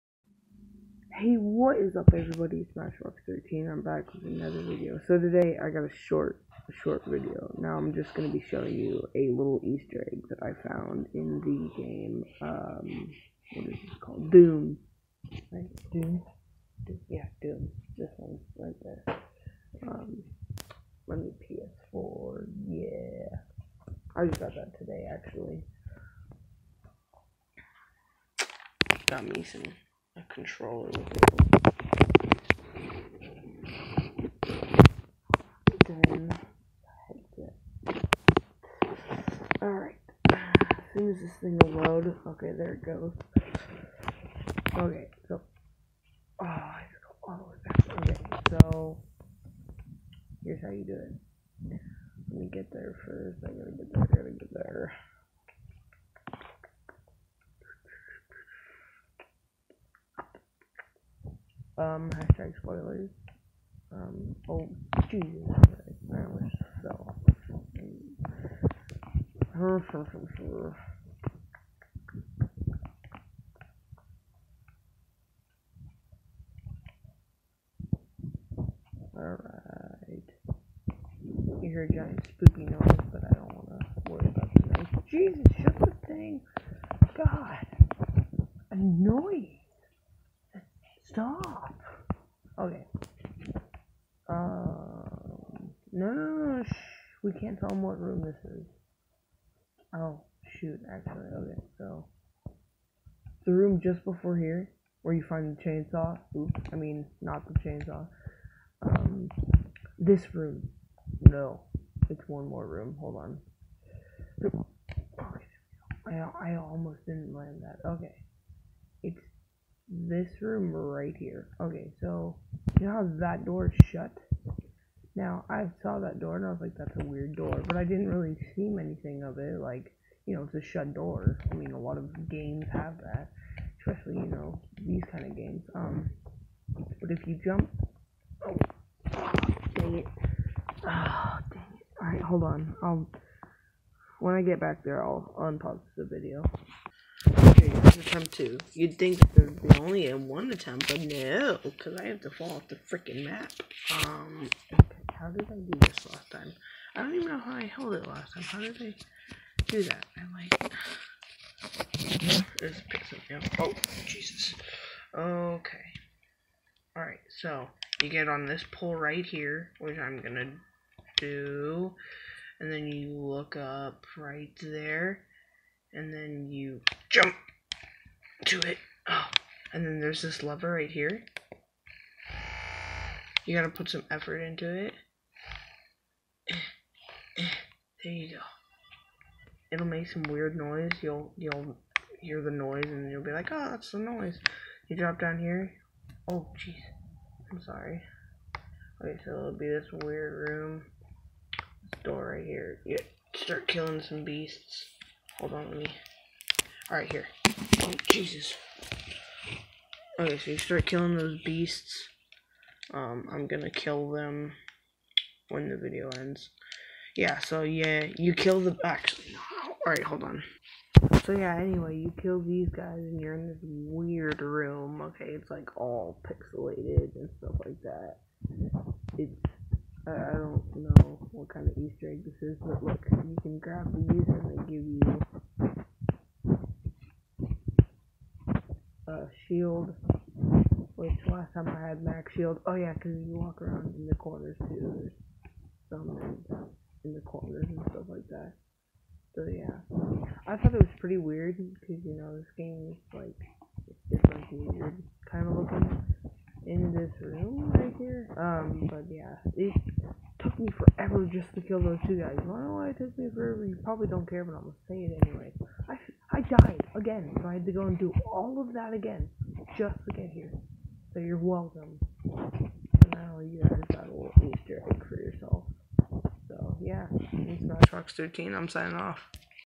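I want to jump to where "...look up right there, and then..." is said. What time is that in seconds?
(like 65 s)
173 s.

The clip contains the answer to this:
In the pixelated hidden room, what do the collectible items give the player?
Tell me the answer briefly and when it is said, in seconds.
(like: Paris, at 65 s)
a shield, at 239 s.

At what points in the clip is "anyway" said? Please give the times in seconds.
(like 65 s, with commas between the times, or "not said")
221 s, 265 s.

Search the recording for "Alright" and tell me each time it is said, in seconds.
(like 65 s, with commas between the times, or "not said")
39 s, 79 s, 166 s, 206 s, 219 s.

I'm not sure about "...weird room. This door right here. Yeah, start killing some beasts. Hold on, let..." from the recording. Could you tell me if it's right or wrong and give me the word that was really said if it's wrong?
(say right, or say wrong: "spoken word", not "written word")
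right.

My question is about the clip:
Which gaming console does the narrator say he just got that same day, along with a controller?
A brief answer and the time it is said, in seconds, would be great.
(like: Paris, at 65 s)
PS4, at 21 s.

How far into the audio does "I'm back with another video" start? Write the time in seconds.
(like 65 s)
3 s.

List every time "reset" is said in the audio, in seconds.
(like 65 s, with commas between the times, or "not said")
not said.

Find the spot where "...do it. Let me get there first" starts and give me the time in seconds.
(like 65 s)
50 s.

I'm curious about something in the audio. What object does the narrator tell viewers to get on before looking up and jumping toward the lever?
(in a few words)
pole.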